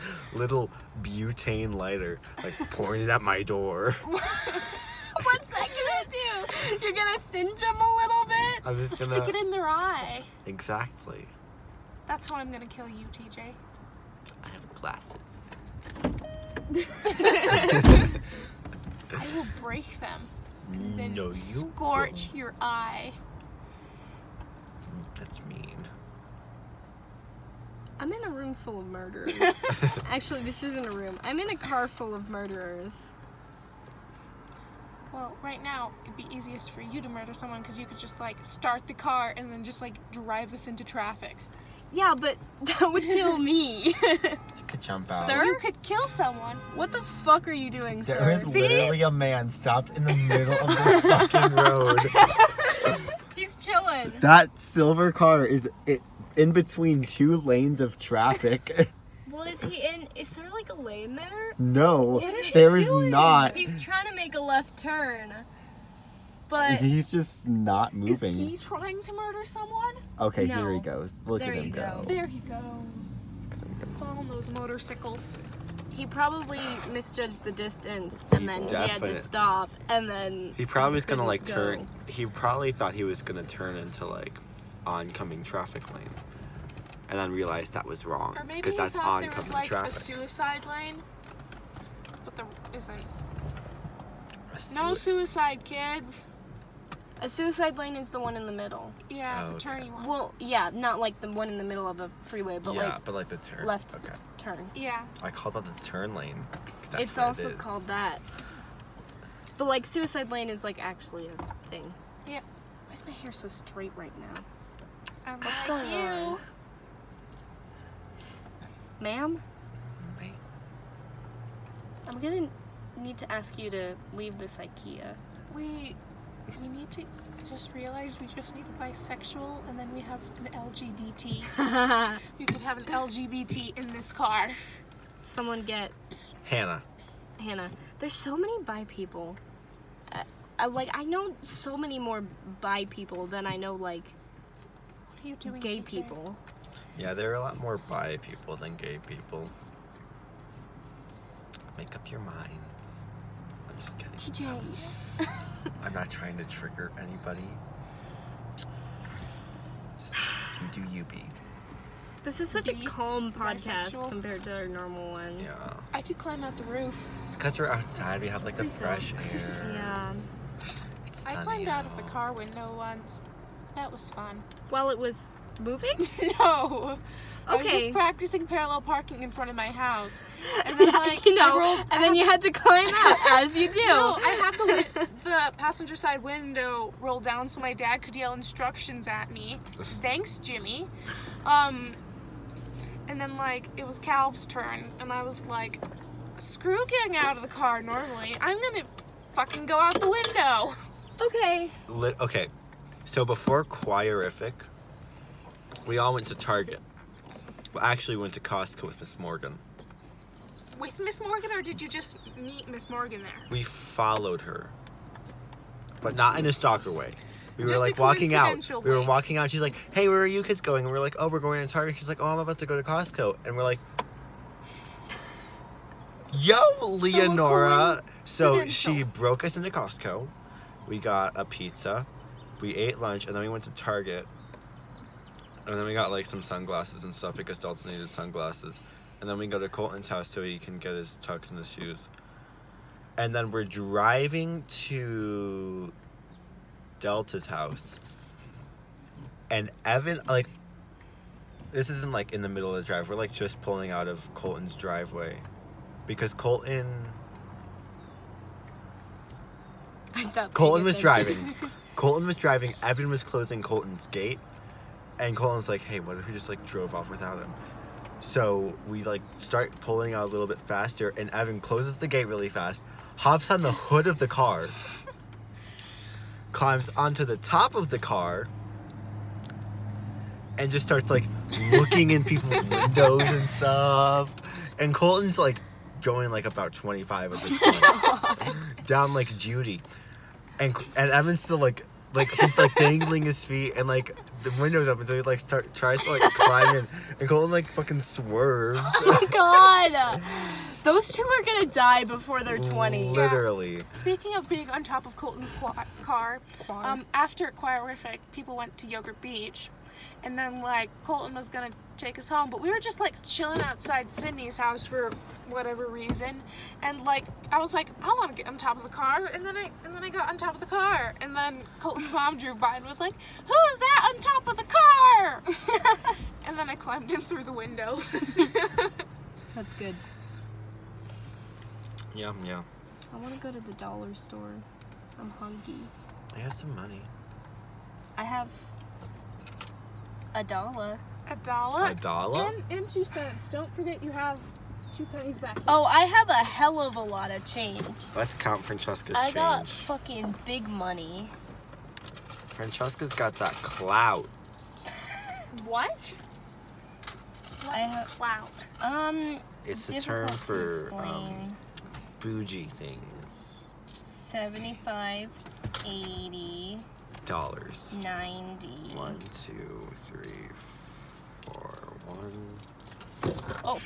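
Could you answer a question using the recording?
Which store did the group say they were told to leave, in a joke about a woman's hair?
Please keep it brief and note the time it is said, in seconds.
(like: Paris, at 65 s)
IKEA, at 124 s.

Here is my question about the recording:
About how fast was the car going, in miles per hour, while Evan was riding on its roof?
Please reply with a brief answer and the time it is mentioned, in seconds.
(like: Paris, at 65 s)
25, at 286 s.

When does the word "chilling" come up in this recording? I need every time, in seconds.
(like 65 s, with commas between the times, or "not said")
53 s, 313 s.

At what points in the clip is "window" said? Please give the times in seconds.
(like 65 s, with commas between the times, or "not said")
172 s, 186 s, 200 s, 282 s, 294 s, 327 s.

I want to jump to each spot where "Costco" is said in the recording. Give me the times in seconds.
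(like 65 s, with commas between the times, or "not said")
208 s, 222 s, 229 s.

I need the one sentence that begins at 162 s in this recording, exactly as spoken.
This is such be a calm podcast bisexual.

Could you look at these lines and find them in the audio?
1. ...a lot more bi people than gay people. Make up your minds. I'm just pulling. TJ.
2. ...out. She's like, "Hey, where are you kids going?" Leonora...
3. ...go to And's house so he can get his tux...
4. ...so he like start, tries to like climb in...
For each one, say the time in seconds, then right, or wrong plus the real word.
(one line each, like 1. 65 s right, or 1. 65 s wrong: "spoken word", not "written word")
1. 147 s wrong: "kidding", not "pulling"
2. 219 s wrong: "And", not "Leonora"
3. 239 s wrong: "Colton", not "And"
4. 295 s right.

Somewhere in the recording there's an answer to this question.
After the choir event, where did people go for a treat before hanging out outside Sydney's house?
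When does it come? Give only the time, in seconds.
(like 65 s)
308 s.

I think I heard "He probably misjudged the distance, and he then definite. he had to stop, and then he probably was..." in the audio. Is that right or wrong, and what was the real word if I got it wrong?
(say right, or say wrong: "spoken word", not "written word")
right.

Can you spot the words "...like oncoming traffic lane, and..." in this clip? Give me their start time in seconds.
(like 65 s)
84 s.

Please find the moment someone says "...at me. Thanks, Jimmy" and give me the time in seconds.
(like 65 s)
189 s.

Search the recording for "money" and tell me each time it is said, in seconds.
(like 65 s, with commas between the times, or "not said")
336 s, 350 s.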